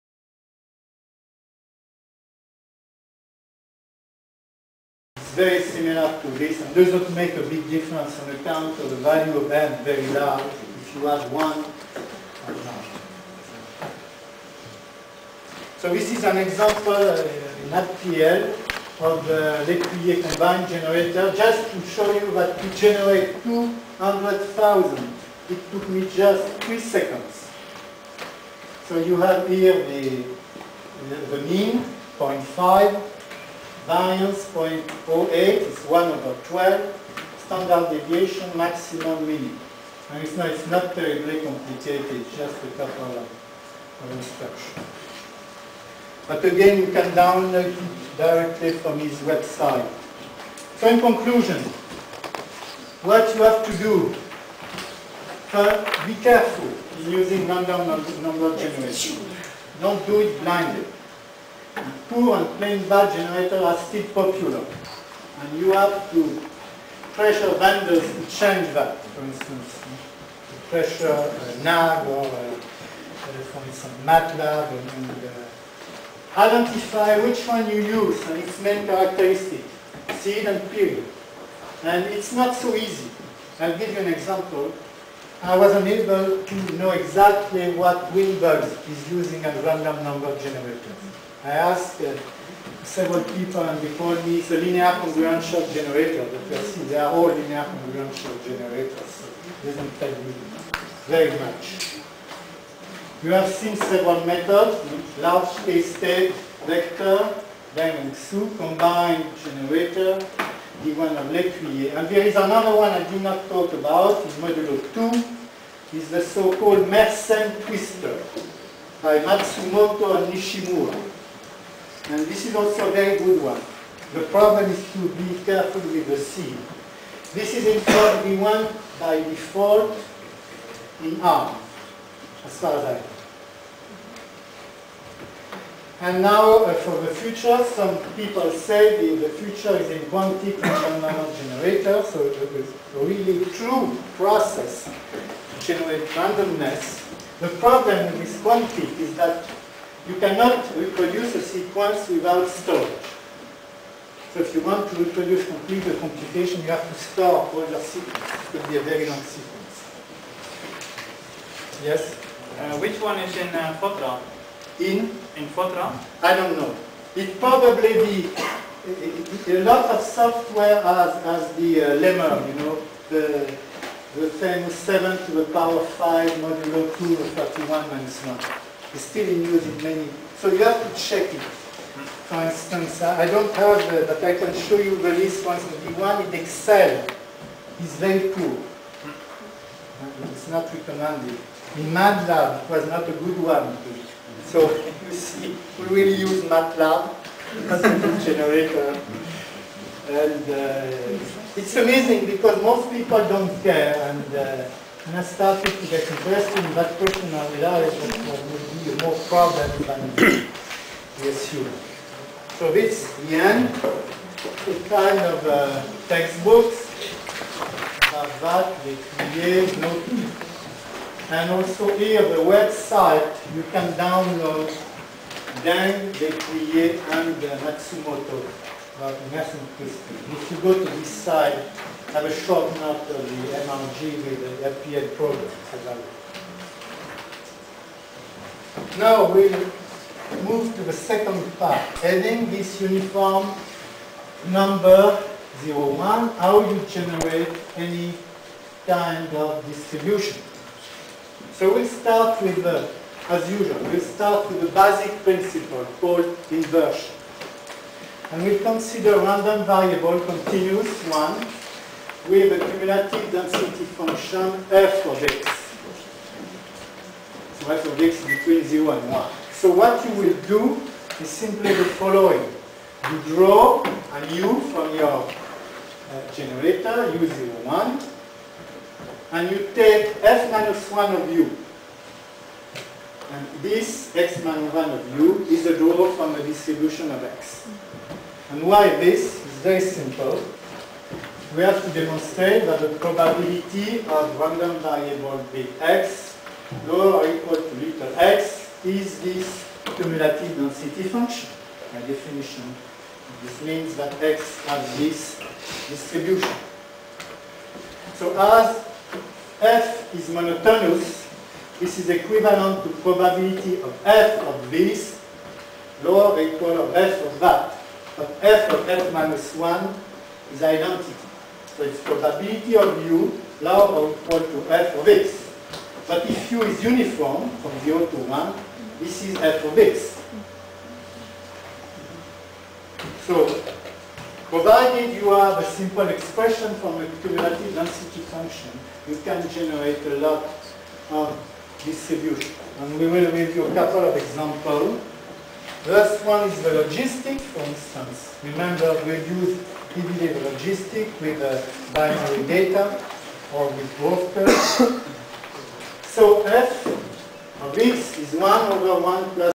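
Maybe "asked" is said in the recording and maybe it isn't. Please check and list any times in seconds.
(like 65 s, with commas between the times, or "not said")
91 s.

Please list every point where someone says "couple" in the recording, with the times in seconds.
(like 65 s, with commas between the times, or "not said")
42 s, 343 s.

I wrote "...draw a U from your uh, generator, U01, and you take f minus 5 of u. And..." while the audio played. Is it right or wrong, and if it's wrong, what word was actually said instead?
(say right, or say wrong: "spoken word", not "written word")
wrong: "1", not "5".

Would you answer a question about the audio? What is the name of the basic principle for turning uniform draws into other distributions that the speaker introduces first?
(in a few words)
inversion.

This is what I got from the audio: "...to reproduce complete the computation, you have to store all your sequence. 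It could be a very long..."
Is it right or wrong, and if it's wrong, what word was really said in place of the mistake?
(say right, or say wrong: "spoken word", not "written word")
right.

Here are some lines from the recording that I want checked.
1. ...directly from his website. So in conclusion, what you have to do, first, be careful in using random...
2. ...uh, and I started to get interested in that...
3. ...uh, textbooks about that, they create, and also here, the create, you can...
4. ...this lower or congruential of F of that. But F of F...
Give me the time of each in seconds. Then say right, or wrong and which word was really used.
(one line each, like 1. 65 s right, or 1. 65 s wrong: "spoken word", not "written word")
1. 48 s right
2. 204 s right
3. 215 s wrong: "website", not "create"
4. 314 s wrong: "equal", not "congruential".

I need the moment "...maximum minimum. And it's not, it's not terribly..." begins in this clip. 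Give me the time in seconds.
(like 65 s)
38 s.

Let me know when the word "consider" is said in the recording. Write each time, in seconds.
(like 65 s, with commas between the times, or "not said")
258 s.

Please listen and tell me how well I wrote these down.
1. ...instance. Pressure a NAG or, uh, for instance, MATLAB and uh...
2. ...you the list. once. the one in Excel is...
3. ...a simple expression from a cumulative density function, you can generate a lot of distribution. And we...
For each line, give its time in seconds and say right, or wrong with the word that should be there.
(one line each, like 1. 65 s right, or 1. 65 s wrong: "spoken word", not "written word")
1. 69 s right
2. 184 s right
3. 335 s right.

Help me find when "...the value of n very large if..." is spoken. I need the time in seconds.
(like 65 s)
8 s.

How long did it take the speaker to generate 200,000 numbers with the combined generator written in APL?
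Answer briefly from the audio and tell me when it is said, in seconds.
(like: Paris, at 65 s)
3 seconds, at 26 s.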